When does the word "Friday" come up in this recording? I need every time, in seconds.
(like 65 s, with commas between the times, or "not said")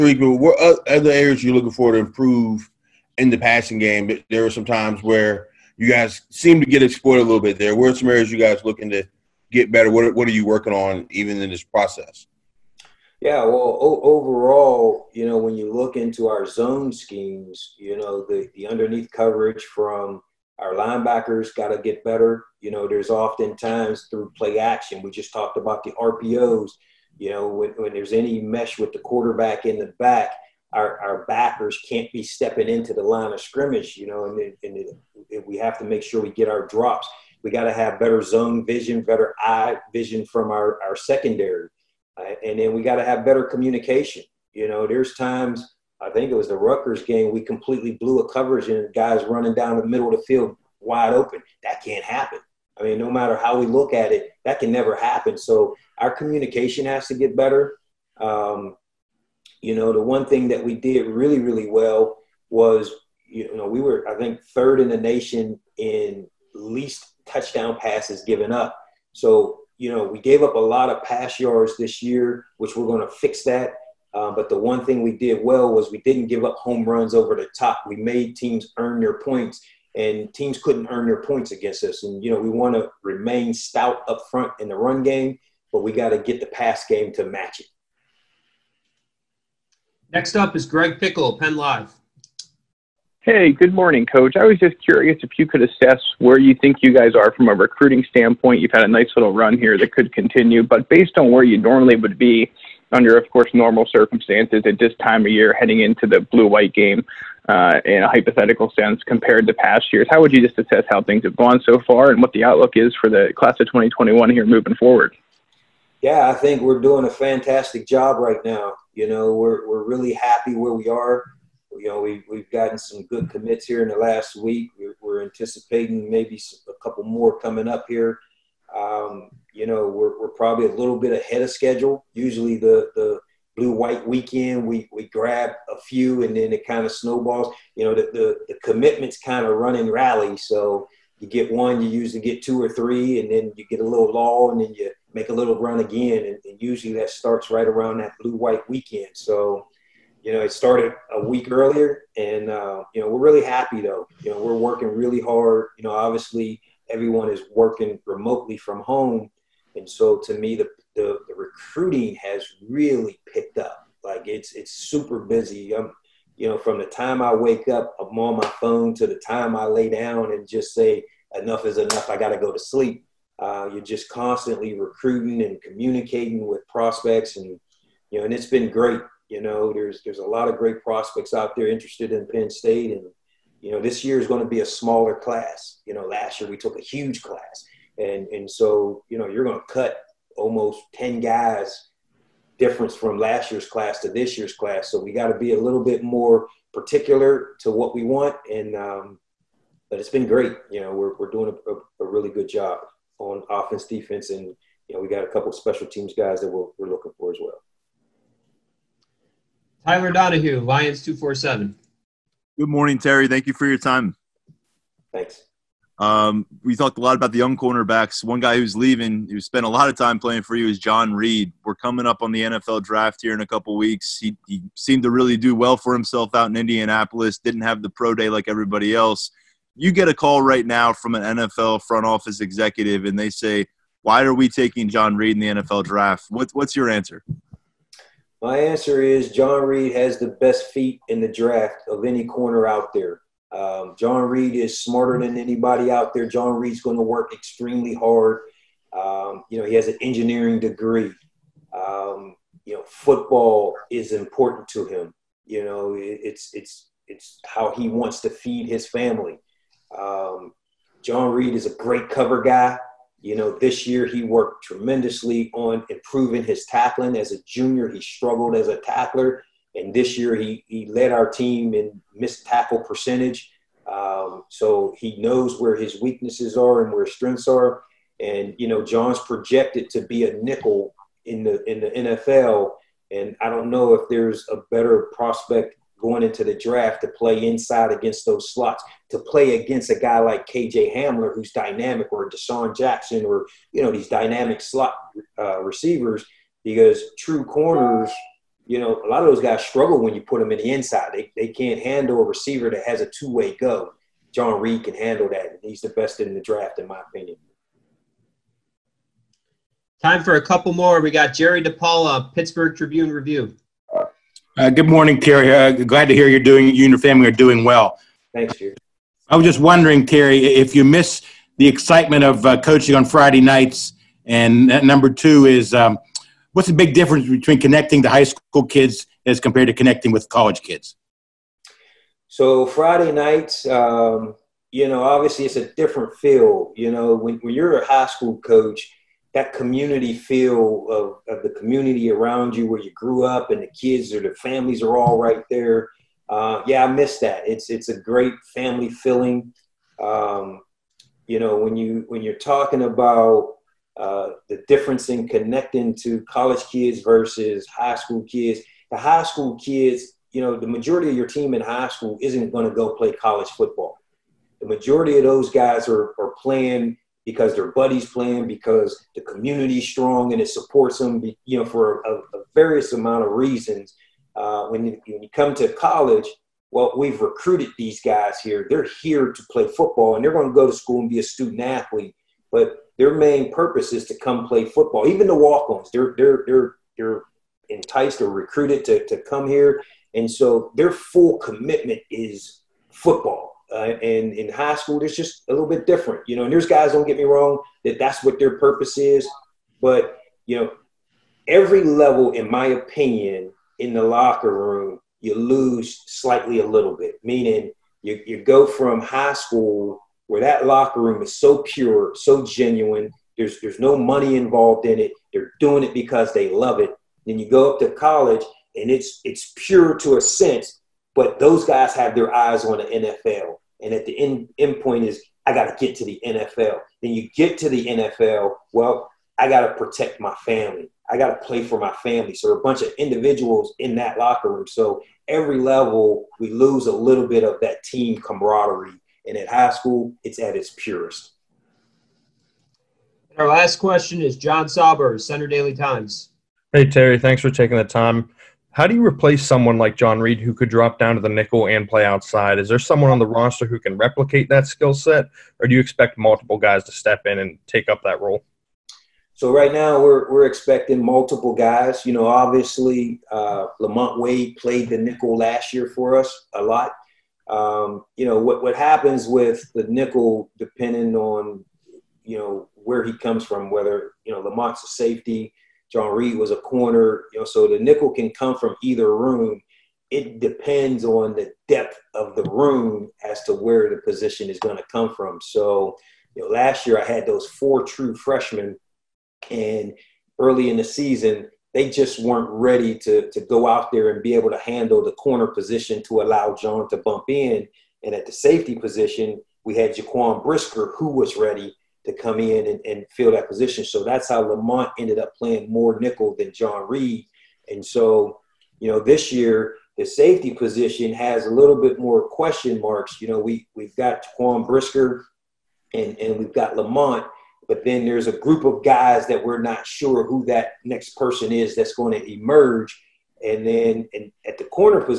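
323 s, 332 s.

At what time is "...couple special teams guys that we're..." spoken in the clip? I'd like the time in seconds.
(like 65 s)
205 s.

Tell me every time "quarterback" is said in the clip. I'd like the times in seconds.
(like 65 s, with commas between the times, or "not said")
28 s.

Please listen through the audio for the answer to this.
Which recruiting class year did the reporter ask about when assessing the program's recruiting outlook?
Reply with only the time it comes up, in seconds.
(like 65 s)
113 s.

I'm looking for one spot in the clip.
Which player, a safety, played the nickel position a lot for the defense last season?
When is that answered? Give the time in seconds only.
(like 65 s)
463 s.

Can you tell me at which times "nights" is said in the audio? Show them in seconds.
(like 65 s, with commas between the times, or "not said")
323 s, 333 s.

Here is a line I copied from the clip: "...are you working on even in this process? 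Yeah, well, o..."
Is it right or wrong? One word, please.
right.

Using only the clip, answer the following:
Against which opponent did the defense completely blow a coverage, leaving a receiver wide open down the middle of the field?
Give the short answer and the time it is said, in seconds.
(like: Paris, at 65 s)
Rutgers, at 46 s.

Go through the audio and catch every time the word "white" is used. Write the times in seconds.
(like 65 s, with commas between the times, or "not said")
106 s, 133 s, 148 s.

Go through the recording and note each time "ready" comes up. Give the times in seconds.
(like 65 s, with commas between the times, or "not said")
492 s, 501 s.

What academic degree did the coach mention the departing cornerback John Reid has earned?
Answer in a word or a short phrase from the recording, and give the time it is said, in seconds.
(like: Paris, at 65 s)
engineering degree, at 249 s.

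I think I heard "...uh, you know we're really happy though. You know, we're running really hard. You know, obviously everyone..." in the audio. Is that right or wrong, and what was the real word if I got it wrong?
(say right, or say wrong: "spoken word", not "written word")
wrong: "working", not "running".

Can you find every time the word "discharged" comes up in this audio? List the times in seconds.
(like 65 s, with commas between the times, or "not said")
not said.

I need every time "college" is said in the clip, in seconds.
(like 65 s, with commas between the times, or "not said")
330 s, 356 s, 363 s, 375 s, 417 s.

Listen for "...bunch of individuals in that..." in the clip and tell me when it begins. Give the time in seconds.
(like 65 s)
432 s.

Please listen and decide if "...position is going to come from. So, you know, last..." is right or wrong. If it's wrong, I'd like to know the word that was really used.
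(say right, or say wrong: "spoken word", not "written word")
right.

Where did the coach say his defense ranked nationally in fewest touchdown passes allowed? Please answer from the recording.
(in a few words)
third.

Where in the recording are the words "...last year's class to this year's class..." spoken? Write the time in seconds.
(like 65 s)
193 s.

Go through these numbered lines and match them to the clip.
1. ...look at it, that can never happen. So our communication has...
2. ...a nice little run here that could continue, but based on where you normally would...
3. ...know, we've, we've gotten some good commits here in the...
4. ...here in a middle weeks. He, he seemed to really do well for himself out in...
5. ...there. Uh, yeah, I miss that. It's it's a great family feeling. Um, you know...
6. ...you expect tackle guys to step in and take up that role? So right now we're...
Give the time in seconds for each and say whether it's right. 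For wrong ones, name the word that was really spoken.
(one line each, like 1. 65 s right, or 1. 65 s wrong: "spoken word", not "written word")
1. 53 s right
2. 98 s right
3. 121 s right
4. 223 s wrong: "couple", not "middle"
5. 345 s right
6. 455 s wrong: "multiple", not "tackle".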